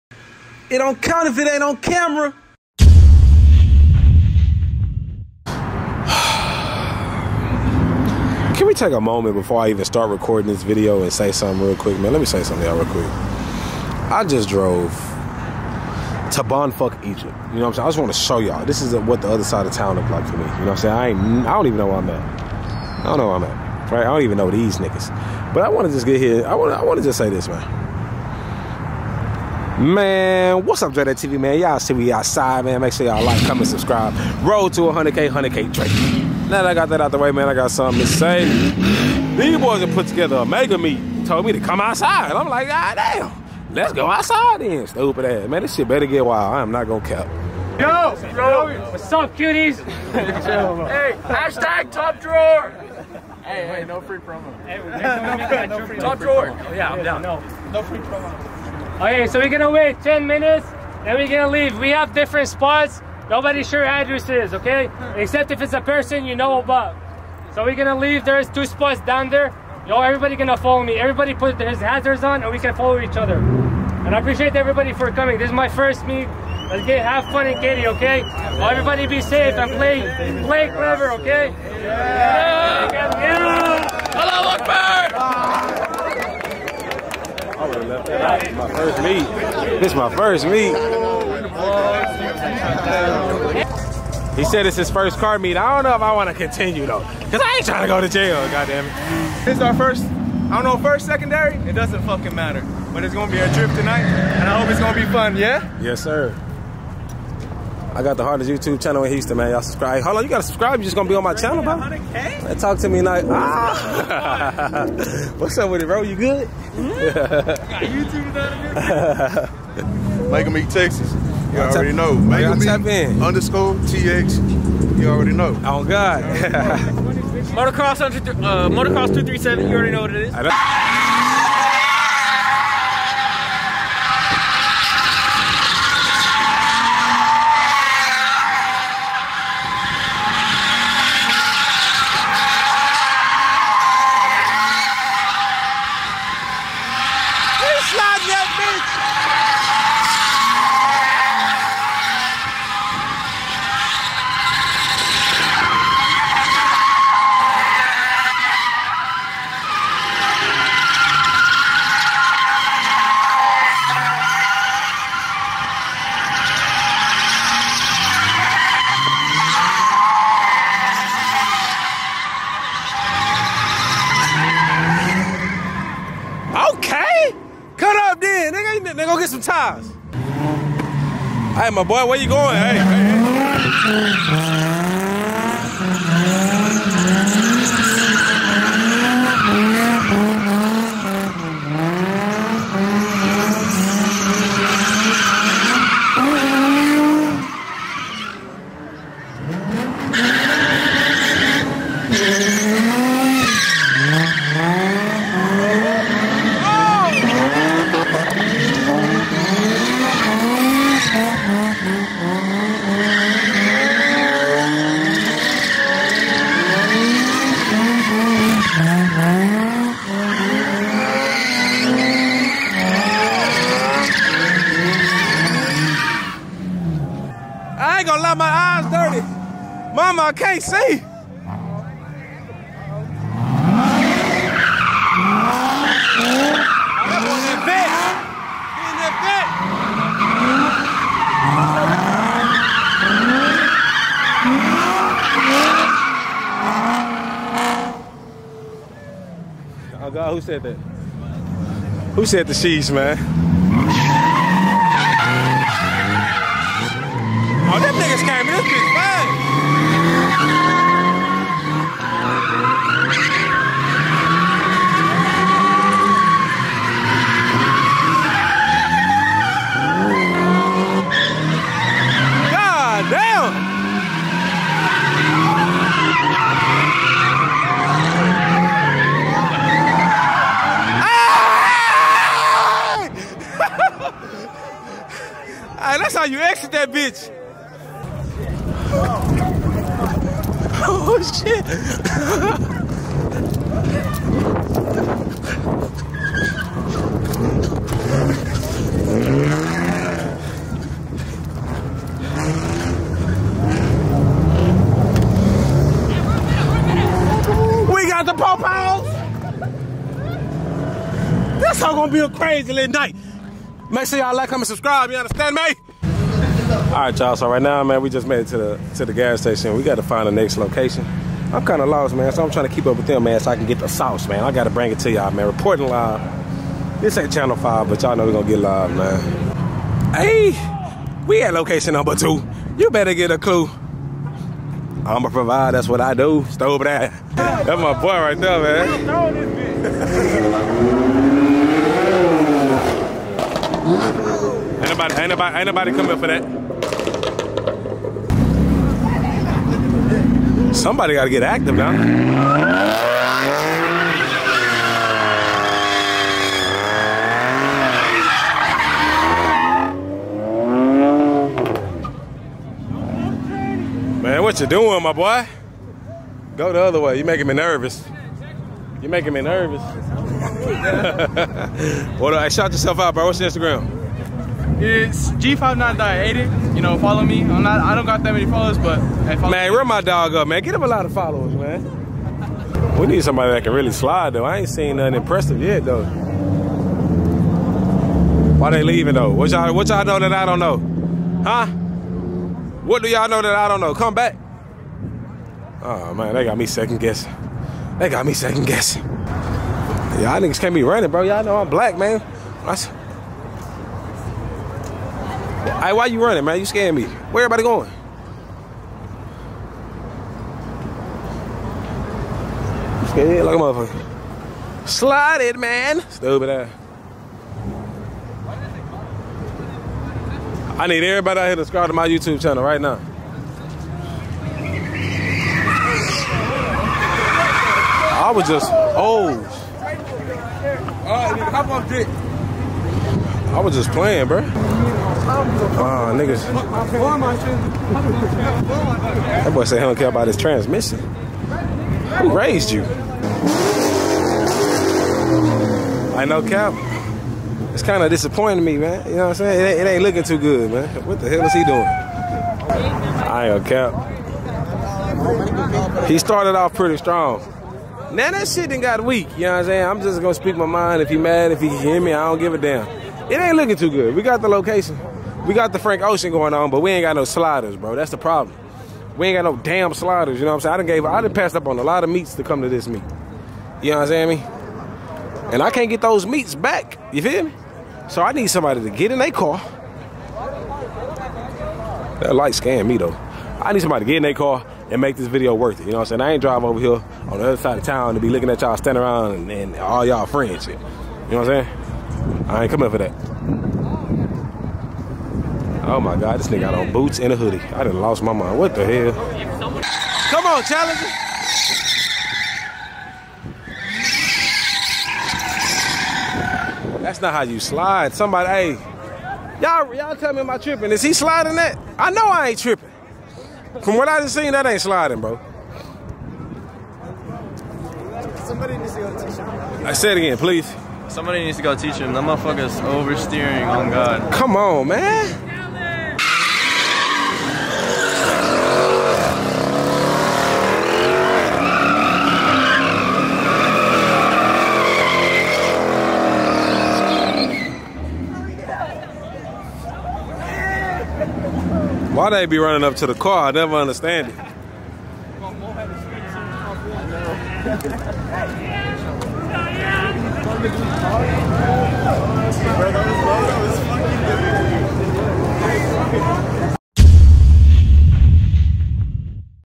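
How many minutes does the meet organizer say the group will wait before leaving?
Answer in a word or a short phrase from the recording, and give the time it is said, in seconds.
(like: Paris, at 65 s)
10, at 60 s.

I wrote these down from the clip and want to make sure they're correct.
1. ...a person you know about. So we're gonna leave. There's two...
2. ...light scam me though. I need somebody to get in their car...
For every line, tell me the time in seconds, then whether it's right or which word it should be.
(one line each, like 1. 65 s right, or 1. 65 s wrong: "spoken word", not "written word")
1. 65 s right
2. 482 s right.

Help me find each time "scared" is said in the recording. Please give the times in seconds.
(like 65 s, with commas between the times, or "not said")
406 s, 413 s.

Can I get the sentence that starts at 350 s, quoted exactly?
Somebody got to get active now.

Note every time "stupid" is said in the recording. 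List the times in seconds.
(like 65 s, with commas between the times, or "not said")
44 s, 416 s.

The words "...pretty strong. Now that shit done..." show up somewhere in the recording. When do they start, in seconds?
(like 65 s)
456 s.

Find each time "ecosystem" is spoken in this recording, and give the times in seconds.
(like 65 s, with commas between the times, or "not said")
not said.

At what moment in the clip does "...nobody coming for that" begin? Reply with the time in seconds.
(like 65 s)
345 s.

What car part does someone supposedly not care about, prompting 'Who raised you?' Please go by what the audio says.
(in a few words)
transmission.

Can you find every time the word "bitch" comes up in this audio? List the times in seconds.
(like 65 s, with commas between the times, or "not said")
258 s, 286 s.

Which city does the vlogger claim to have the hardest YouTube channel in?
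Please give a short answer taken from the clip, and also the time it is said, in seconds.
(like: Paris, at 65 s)
Houston, at 109 s.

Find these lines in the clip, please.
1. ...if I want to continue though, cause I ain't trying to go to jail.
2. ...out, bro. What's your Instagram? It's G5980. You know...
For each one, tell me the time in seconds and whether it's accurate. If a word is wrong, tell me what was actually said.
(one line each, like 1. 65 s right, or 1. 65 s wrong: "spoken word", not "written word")
1. 95 s right
2. 372 s right.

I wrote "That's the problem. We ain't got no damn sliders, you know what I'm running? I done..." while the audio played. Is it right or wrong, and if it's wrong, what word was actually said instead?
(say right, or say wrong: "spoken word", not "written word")
wrong: "saying", not "running".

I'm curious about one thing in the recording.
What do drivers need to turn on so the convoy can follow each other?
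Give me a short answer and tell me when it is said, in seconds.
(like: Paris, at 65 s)
hazards, at 71 s.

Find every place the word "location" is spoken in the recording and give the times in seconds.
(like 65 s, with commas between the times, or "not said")
320 s, 331 s, 464 s.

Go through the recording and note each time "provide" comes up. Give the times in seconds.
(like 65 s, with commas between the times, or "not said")
335 s.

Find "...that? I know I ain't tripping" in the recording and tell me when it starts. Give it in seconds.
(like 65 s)
511 s.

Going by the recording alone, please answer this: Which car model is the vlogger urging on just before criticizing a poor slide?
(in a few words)
Challenger.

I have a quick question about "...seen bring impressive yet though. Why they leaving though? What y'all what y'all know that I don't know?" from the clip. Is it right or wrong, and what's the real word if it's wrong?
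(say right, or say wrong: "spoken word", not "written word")
wrong: "nothing", not "bring".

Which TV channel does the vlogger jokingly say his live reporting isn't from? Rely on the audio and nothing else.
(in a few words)
Channel 5.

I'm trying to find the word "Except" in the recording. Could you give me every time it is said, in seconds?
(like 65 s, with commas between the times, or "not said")
65 s.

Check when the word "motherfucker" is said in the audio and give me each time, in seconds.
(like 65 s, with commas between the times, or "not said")
413 s, 522 s.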